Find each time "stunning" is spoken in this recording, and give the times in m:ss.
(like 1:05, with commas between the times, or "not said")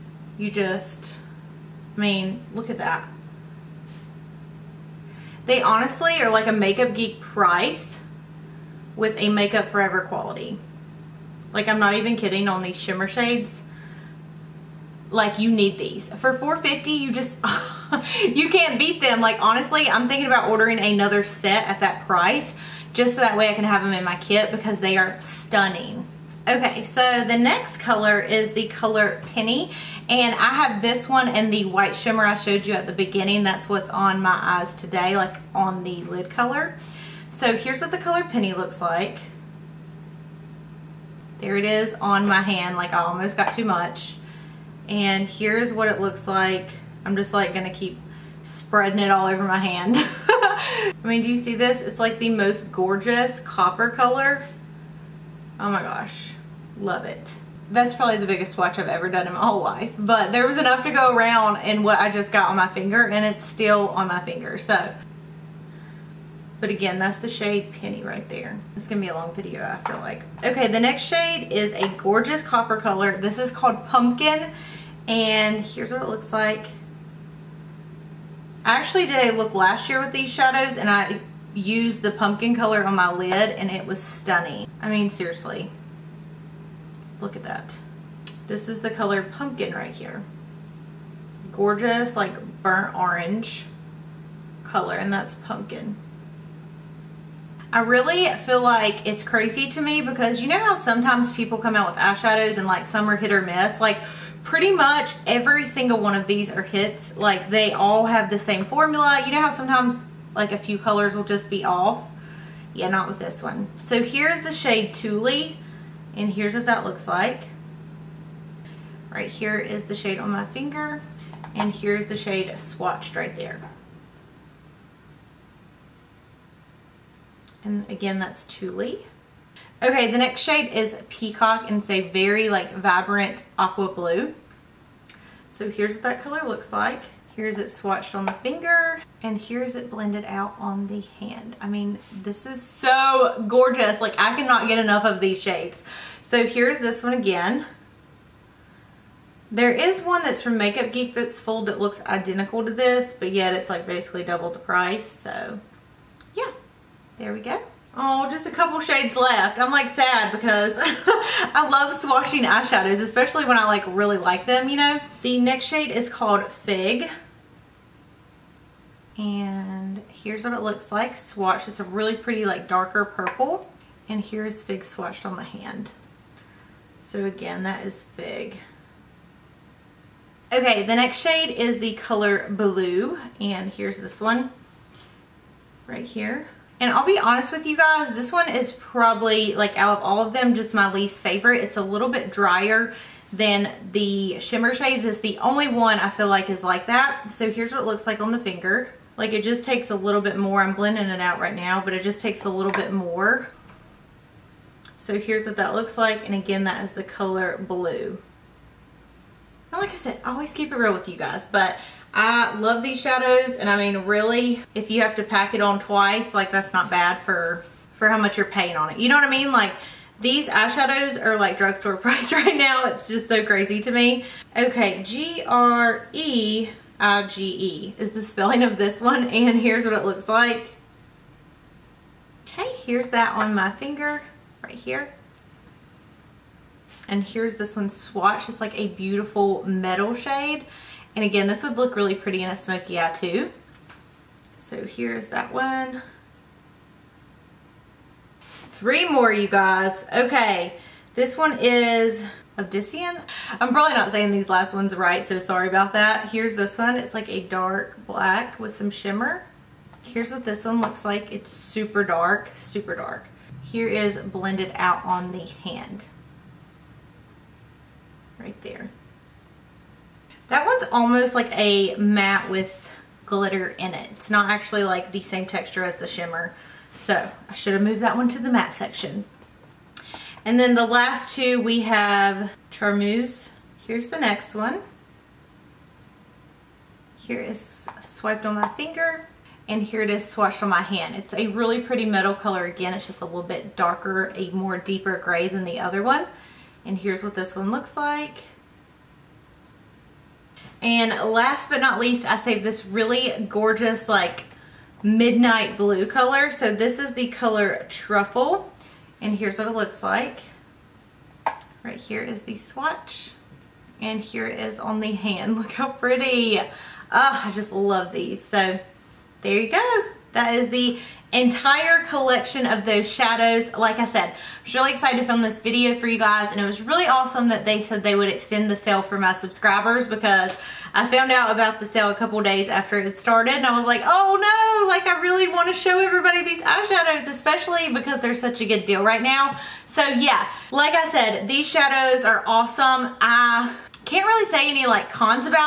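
0:25, 1:24.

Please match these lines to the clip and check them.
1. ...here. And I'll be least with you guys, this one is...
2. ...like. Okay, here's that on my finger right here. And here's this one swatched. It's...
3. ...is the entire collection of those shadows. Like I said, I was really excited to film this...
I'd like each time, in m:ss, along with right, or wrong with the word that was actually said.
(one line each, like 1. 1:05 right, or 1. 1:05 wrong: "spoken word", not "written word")
1. 3:06 wrong: "honest", not "least"
2. 3:50 right
3. 5:20 right.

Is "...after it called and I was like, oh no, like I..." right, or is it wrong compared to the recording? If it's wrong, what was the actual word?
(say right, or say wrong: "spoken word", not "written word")
wrong: "started", not "called".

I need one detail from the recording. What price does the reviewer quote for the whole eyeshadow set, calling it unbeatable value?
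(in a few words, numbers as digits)
450.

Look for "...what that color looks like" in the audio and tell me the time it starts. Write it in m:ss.
2:15.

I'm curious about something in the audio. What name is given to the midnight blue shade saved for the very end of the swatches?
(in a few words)
Truffle.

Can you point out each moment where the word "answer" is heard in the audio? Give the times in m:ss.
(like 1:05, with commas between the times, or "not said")
not said.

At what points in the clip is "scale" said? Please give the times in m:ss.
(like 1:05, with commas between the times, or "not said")
not said.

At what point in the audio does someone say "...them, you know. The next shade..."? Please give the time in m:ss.
2:44.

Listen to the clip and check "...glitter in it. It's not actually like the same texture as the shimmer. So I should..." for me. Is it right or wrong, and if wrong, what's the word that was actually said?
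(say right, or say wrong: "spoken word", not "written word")
right.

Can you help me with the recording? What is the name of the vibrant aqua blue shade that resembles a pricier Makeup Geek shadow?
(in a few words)
Peacock.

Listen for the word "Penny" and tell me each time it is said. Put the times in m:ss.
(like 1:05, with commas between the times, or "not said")
0:29, 0:38, 1:07.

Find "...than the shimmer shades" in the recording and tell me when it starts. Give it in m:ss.
3:13.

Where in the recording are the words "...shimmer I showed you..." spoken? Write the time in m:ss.
0:31.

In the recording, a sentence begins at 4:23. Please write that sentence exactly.
Here is blended out on the hand.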